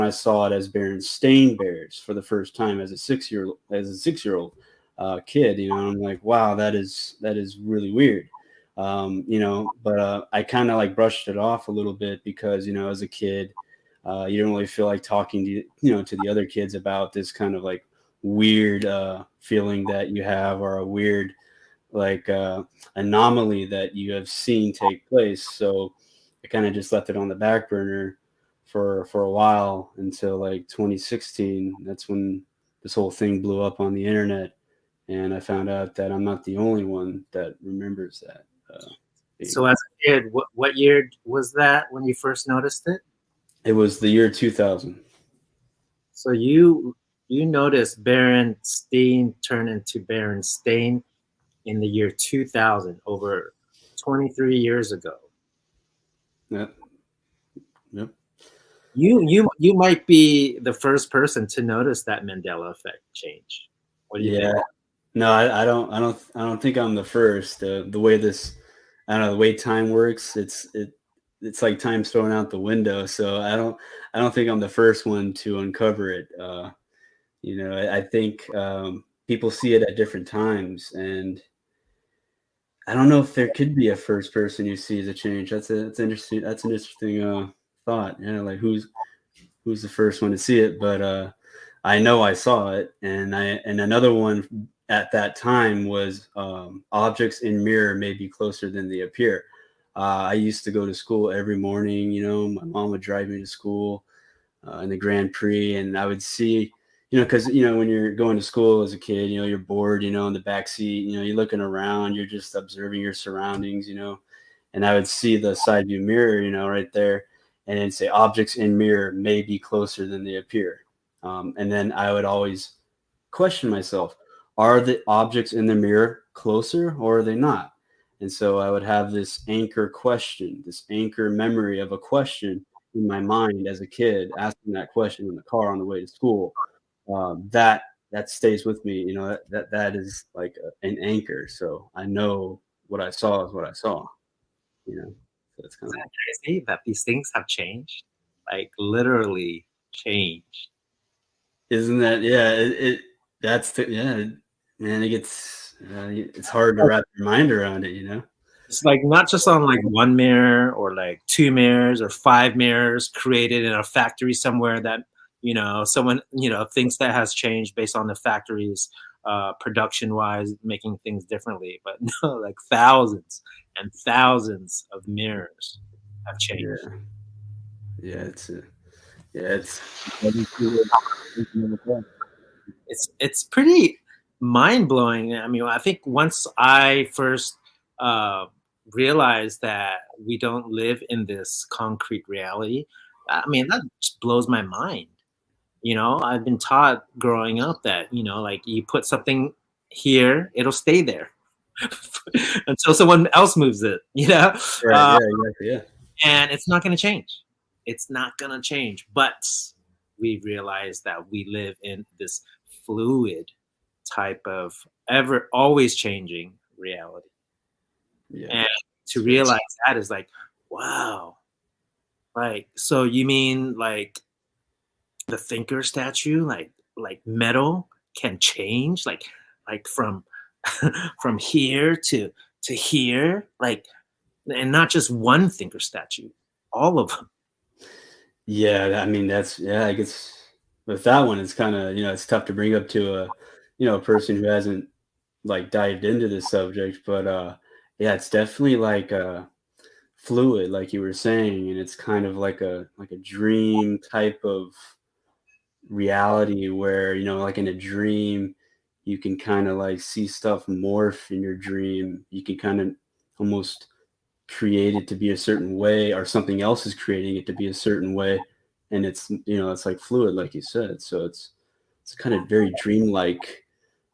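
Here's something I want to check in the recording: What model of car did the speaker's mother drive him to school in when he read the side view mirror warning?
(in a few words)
Grand Prix.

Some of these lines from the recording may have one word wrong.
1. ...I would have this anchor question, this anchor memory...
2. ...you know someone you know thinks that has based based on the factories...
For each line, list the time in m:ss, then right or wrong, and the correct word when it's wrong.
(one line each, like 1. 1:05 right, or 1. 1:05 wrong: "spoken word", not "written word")
1. 2:08 right
2. 2:45 wrong: "changed", not "based".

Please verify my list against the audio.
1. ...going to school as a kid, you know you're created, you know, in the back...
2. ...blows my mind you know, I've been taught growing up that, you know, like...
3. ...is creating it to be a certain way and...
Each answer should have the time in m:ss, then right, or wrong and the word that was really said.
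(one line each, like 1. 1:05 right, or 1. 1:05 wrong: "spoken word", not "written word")
1. 1:48 wrong: "bored", not "created"
2. 3:14 right
3. 4:26 right.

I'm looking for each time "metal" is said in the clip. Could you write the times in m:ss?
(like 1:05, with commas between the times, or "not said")
3:47.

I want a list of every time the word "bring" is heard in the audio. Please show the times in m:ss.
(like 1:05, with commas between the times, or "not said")
4:02.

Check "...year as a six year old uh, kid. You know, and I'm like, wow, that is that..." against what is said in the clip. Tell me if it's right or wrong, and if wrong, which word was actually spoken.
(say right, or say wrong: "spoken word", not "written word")
right.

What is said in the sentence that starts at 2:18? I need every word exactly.
You know, that that, that is like a, an anchor.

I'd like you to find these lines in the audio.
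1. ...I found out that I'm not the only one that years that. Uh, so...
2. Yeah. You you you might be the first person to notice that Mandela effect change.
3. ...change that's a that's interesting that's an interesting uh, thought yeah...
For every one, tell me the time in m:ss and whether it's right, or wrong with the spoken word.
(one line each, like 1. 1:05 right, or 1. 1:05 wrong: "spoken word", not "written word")
1. 0:35 wrong: "remembers", not "years"
2. 0:57 right
3. 1:25 right.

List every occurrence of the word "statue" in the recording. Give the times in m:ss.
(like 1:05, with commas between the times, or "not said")
3:45, 3:55.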